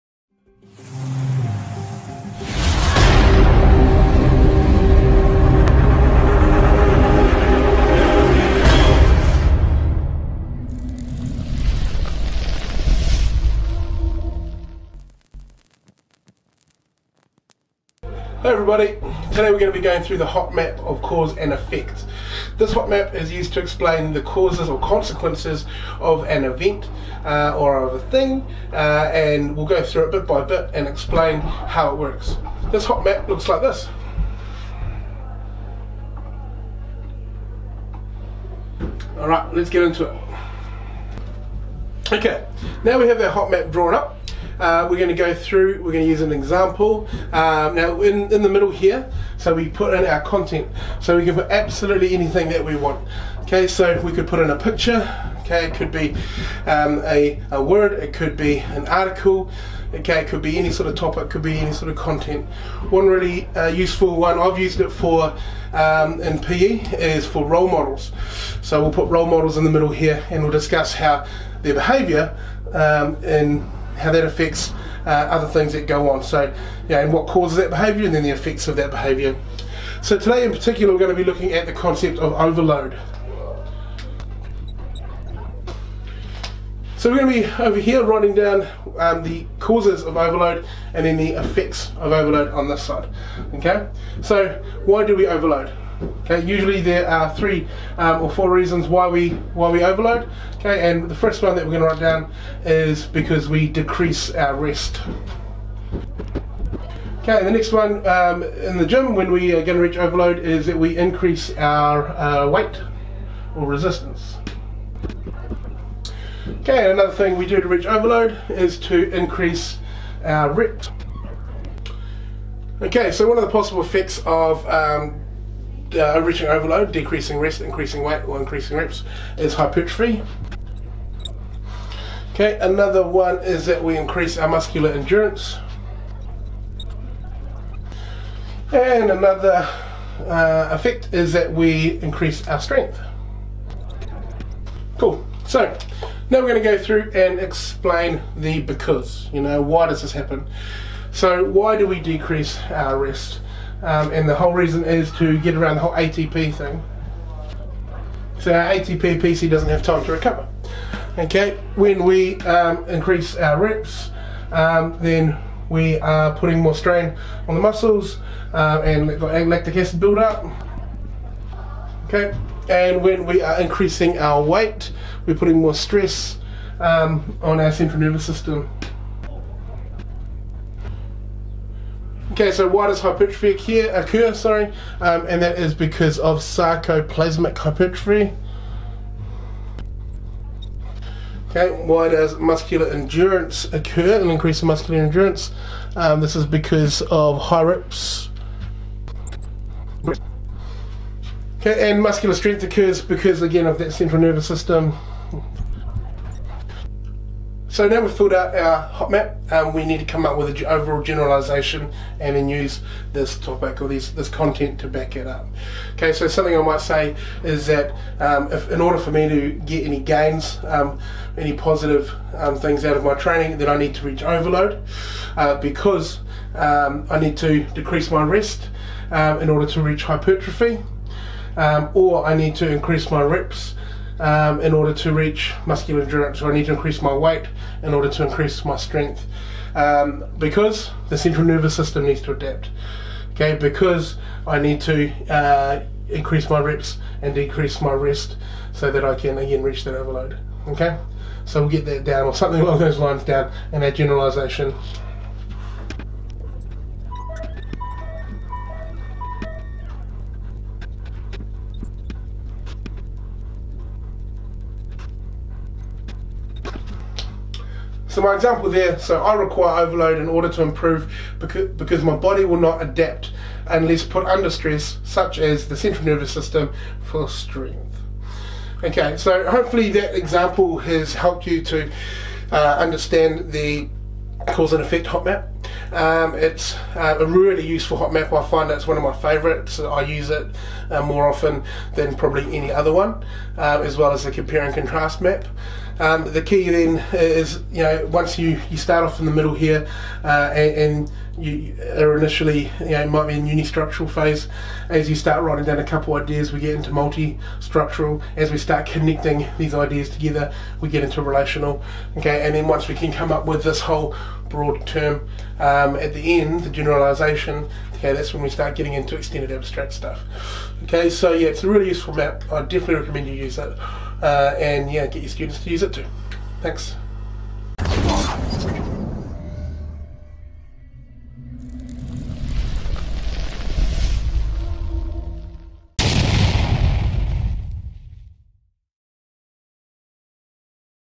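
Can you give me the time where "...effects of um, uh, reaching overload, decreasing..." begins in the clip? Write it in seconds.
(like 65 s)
123 s.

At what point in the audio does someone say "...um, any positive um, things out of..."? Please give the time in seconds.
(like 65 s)
220 s.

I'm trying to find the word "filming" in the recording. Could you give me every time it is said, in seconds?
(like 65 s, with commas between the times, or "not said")
not said.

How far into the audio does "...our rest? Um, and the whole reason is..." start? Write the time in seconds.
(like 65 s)
152 s.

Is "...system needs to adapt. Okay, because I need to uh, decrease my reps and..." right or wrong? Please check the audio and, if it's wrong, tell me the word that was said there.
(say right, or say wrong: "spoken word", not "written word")
wrong: "increase", not "decrease".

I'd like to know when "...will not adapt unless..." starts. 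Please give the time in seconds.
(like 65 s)
272 s.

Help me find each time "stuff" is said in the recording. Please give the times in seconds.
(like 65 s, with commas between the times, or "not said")
319 s.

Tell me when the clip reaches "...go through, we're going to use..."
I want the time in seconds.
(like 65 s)
45 s.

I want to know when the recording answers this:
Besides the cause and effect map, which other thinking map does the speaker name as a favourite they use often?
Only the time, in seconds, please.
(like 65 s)
294 s.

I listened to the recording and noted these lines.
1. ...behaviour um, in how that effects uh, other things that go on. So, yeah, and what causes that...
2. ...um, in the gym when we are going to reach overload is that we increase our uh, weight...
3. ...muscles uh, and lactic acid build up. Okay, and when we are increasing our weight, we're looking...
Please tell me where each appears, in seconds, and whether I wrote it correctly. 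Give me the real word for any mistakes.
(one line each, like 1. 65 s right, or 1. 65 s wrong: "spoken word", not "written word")
1. 71 s wrong: "affects", not "effects"
2. 108 s right
3. 167 s wrong: "putting", not "looking".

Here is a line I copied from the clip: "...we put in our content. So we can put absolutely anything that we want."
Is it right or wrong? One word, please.
right.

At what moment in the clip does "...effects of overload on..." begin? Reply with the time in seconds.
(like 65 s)
91 s.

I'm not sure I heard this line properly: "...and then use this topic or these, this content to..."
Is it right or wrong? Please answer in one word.
right.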